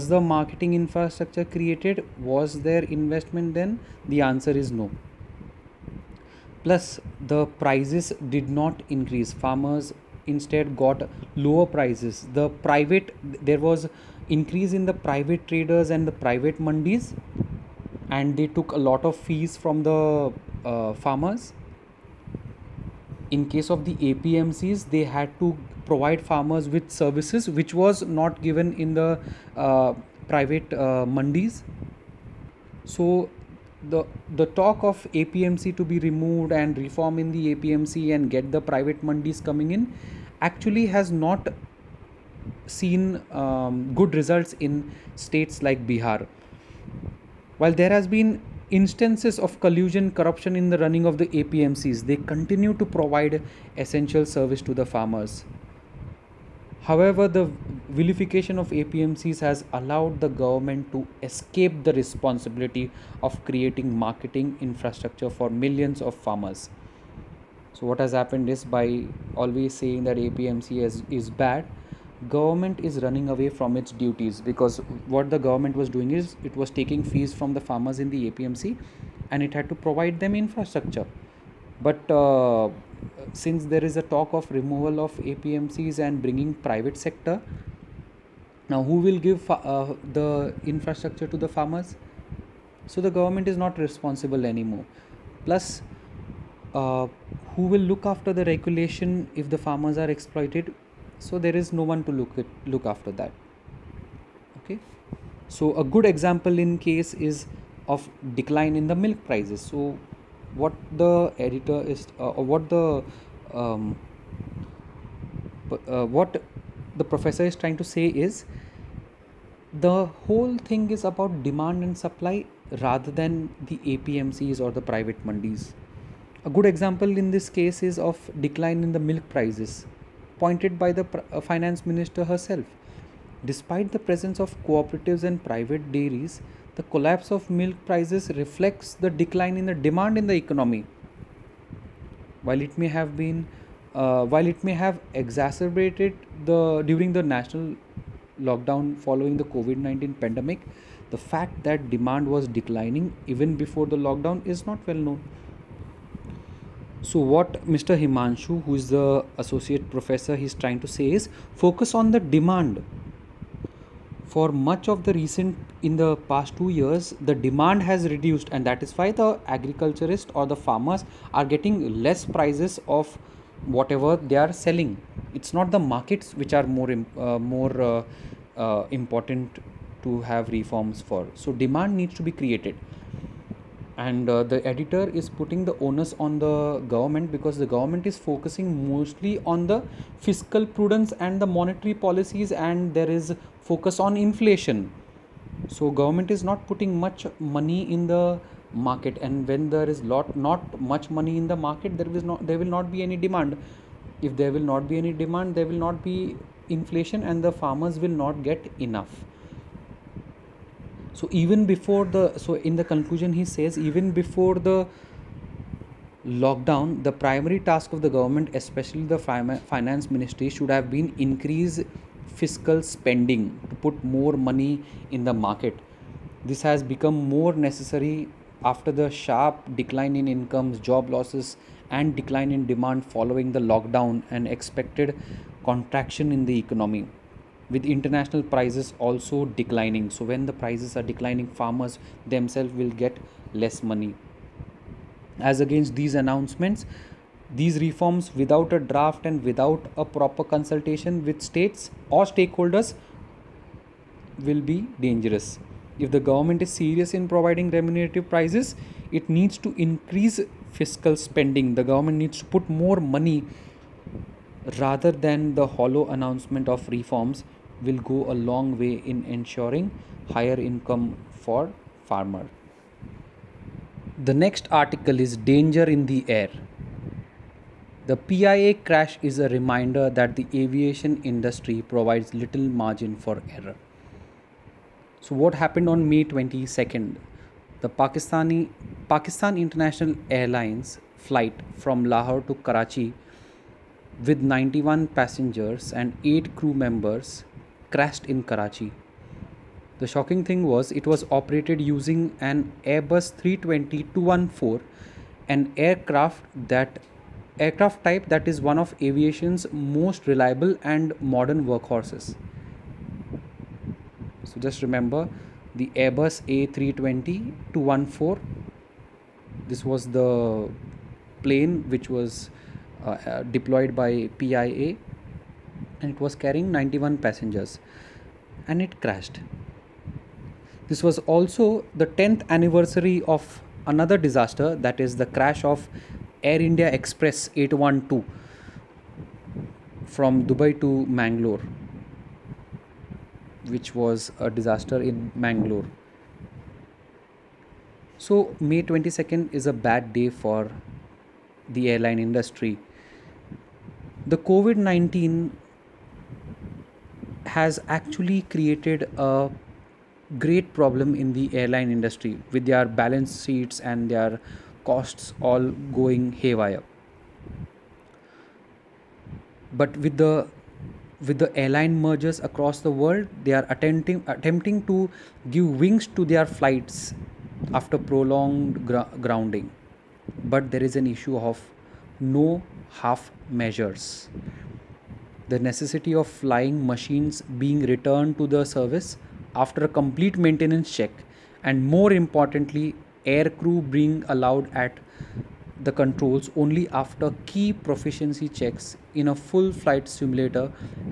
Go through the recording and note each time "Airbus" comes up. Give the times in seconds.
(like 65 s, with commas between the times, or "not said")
302 s, 315 s.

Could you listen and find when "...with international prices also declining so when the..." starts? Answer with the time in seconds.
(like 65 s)
237 s.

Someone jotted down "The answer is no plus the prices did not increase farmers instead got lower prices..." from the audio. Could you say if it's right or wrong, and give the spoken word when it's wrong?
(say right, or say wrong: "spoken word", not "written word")
right.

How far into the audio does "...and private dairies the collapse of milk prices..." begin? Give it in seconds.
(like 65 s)
135 s.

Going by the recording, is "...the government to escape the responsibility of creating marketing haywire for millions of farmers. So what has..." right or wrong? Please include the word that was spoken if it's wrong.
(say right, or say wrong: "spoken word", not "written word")
wrong: "infrastructure", not "haywire".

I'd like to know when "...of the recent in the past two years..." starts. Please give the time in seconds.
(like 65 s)
164 s.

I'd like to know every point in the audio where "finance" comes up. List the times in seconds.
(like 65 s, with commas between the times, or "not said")
131 s, 219 s.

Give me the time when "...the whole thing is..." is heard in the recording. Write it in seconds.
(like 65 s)
119 s.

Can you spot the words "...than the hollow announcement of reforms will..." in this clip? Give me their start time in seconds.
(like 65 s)
265 s.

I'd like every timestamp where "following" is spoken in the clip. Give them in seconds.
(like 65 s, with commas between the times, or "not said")
148 s, 233 s.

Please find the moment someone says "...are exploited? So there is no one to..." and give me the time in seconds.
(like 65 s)
99 s.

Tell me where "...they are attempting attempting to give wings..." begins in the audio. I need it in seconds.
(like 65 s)
373 s.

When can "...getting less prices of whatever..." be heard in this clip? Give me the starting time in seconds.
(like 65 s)
171 s.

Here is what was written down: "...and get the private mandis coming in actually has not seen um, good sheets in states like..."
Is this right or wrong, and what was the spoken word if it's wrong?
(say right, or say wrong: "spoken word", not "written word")
wrong: "results", not "sheets".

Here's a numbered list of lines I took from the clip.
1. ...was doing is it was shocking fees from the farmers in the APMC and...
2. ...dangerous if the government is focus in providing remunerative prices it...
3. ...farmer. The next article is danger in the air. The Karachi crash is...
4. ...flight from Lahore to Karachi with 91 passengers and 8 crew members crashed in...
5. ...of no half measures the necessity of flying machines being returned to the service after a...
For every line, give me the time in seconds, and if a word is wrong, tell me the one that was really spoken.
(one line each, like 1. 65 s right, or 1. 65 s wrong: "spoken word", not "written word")
1. 75 s wrong: "taking", not "shocking"
2. 255 s wrong: "serious", not "focus"
3. 272 s wrong: "PIA", not "Karachi"
4. 291 s right
5. 381 s right.